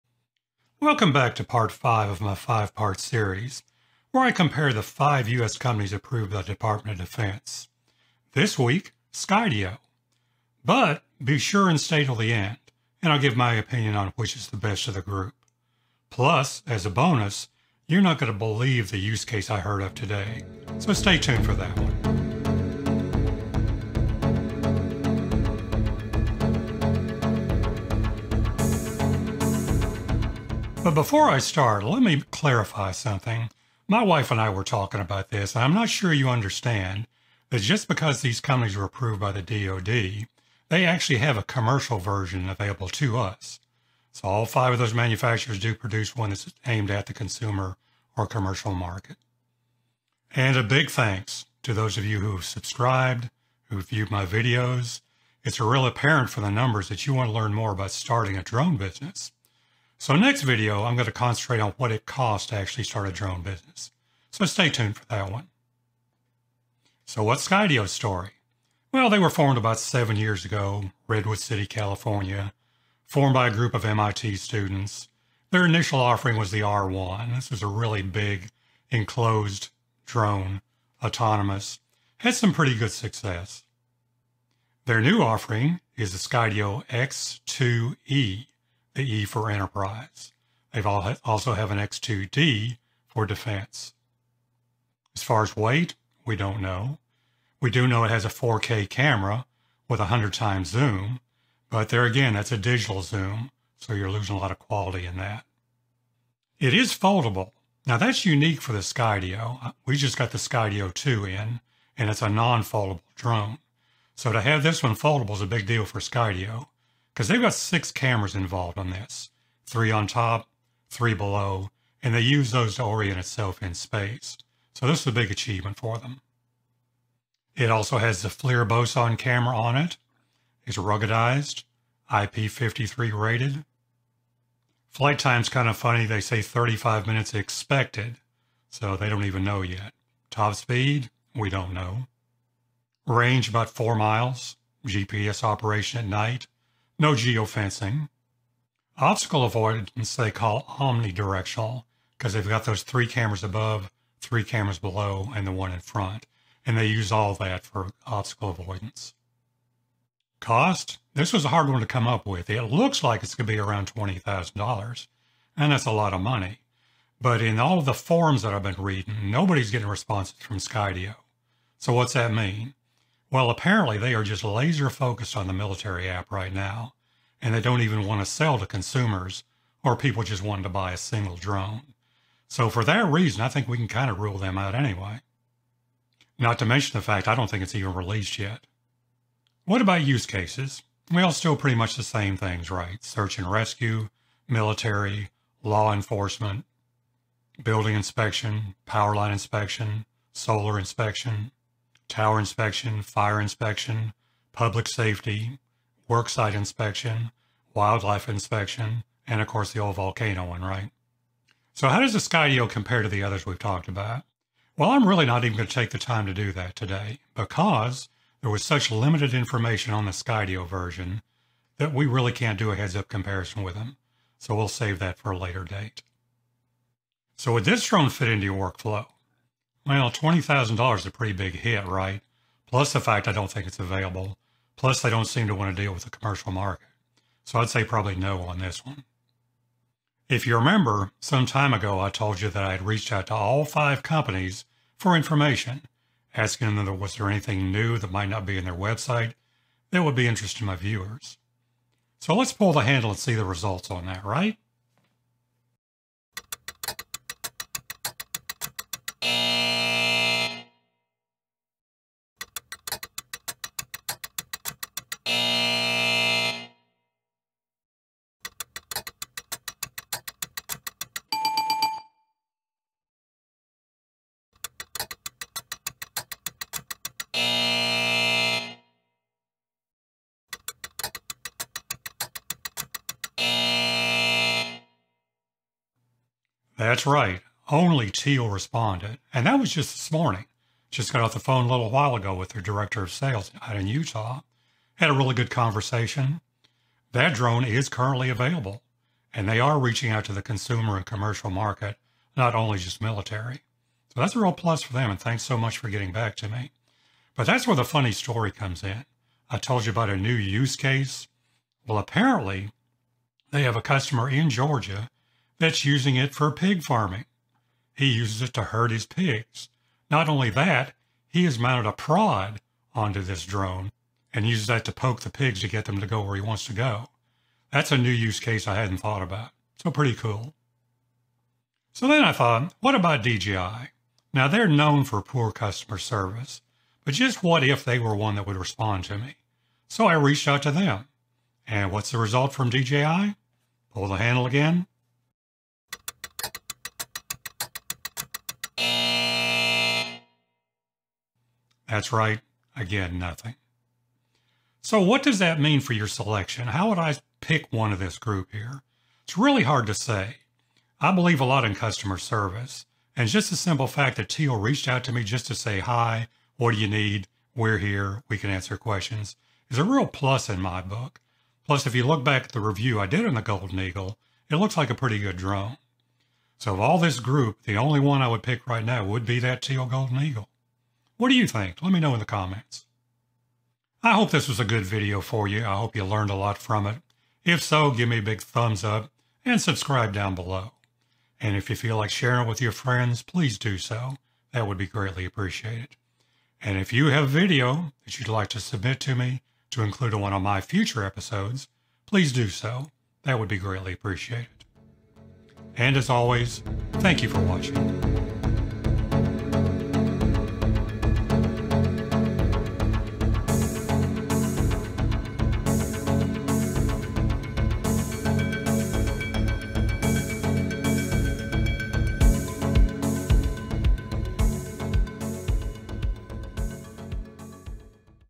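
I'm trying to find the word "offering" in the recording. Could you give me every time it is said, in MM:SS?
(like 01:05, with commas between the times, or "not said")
01:15, 01:25.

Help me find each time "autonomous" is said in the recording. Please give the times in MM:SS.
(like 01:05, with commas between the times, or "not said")
01:21.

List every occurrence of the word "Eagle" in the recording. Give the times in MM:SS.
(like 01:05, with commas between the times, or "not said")
06:13, 06:20.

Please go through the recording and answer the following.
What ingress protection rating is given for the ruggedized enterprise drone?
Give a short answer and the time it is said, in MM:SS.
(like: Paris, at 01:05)
IP53, at 02:12.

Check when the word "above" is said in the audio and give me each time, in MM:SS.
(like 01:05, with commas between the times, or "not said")
02:33.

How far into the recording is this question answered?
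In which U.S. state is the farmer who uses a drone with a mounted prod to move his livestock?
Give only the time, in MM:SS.
05:14.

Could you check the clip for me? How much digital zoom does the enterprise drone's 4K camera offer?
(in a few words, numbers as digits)
100 times.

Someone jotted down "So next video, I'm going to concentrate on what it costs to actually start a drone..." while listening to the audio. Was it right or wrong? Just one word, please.
right.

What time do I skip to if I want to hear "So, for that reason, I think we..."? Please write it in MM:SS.
03:02.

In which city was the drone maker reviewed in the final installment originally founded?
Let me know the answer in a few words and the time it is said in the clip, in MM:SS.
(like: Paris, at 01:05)
Redwood City, at 01:11.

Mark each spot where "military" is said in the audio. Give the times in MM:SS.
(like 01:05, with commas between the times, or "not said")
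02:55, 03:14, 05:02.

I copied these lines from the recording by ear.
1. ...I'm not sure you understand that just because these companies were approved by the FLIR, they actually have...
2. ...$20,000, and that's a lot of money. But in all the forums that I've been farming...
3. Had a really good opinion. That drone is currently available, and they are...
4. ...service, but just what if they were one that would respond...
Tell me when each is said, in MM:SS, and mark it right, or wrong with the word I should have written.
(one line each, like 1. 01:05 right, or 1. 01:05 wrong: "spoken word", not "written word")
1. 00:35 wrong: "DoD", not "FLIR"
2. 02:43 wrong: "reading", not "farming"
3. 04:54 wrong: "conversation", not "opinion"
4. 05:35 right.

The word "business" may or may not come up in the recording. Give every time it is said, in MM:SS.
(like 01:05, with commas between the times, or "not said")
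00:58, 01:03.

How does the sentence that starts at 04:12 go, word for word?
So let's pull the handle and see the results on that, right?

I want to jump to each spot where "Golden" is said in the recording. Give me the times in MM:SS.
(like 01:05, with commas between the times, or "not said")
06:13, 06:19.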